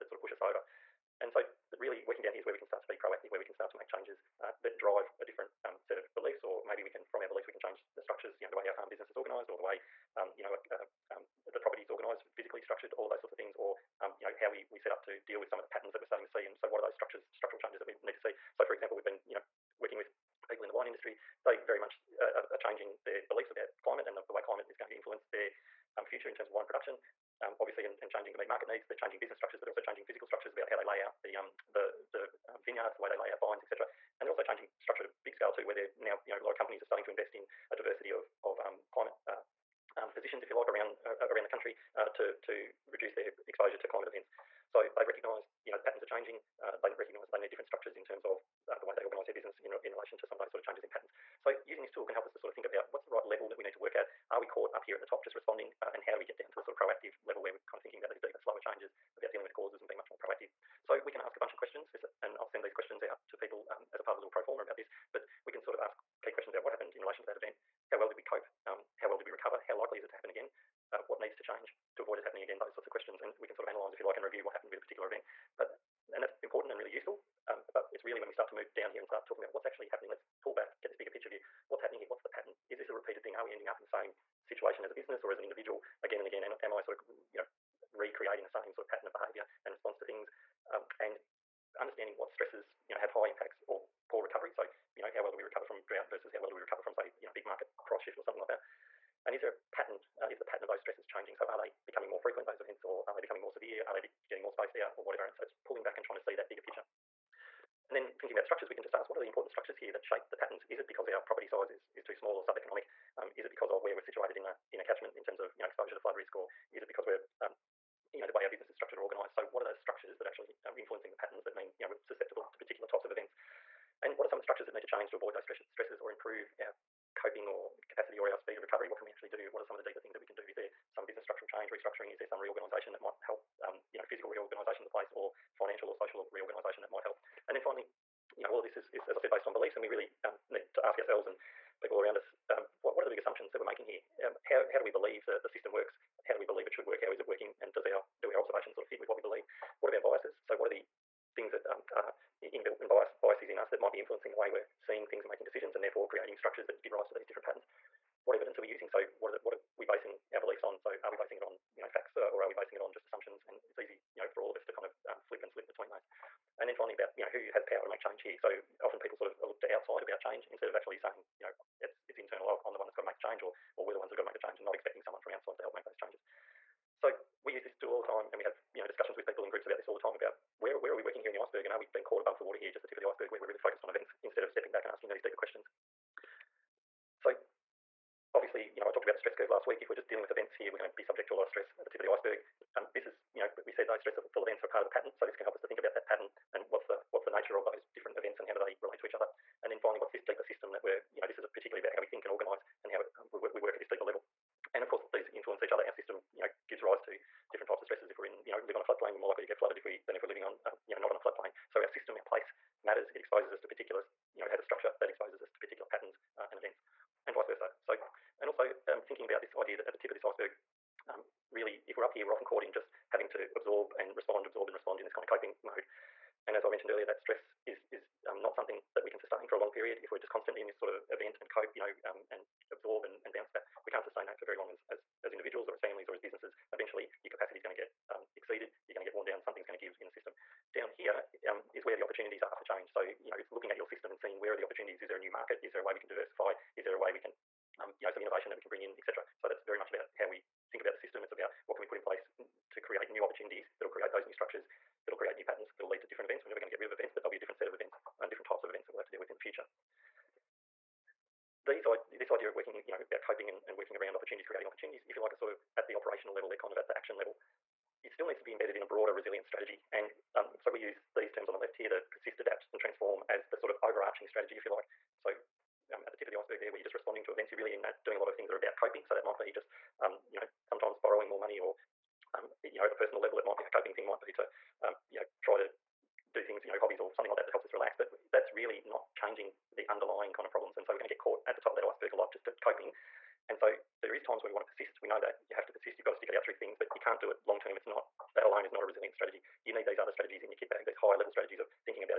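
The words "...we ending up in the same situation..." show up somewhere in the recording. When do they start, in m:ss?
1:23.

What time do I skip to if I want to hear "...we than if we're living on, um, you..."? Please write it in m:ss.
3:29.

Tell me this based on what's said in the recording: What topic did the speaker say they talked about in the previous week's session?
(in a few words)
stress curve.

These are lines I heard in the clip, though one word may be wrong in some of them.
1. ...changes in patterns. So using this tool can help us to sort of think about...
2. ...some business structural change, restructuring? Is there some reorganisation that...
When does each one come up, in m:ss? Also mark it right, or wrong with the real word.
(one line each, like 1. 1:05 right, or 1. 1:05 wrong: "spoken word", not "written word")
1. 0:50 right
2. 2:10 right.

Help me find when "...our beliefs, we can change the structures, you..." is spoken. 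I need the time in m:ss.
0:07.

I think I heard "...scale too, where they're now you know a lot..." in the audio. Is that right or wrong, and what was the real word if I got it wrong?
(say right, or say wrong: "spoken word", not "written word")
right.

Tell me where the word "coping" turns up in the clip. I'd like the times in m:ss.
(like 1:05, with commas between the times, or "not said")
2:07, 3:45, 4:23, 4:38, 4:43, 4:52.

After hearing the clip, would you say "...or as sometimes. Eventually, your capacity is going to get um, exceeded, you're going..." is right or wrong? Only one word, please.
wrong.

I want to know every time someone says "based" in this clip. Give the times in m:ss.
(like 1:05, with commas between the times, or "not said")
2:19.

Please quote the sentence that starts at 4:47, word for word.
But that's really not changing the underlying kind of problems.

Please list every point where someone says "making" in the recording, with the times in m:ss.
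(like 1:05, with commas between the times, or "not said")
2:23, 2:35.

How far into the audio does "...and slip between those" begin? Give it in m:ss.
2:45.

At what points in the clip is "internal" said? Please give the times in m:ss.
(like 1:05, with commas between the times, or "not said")
2:52.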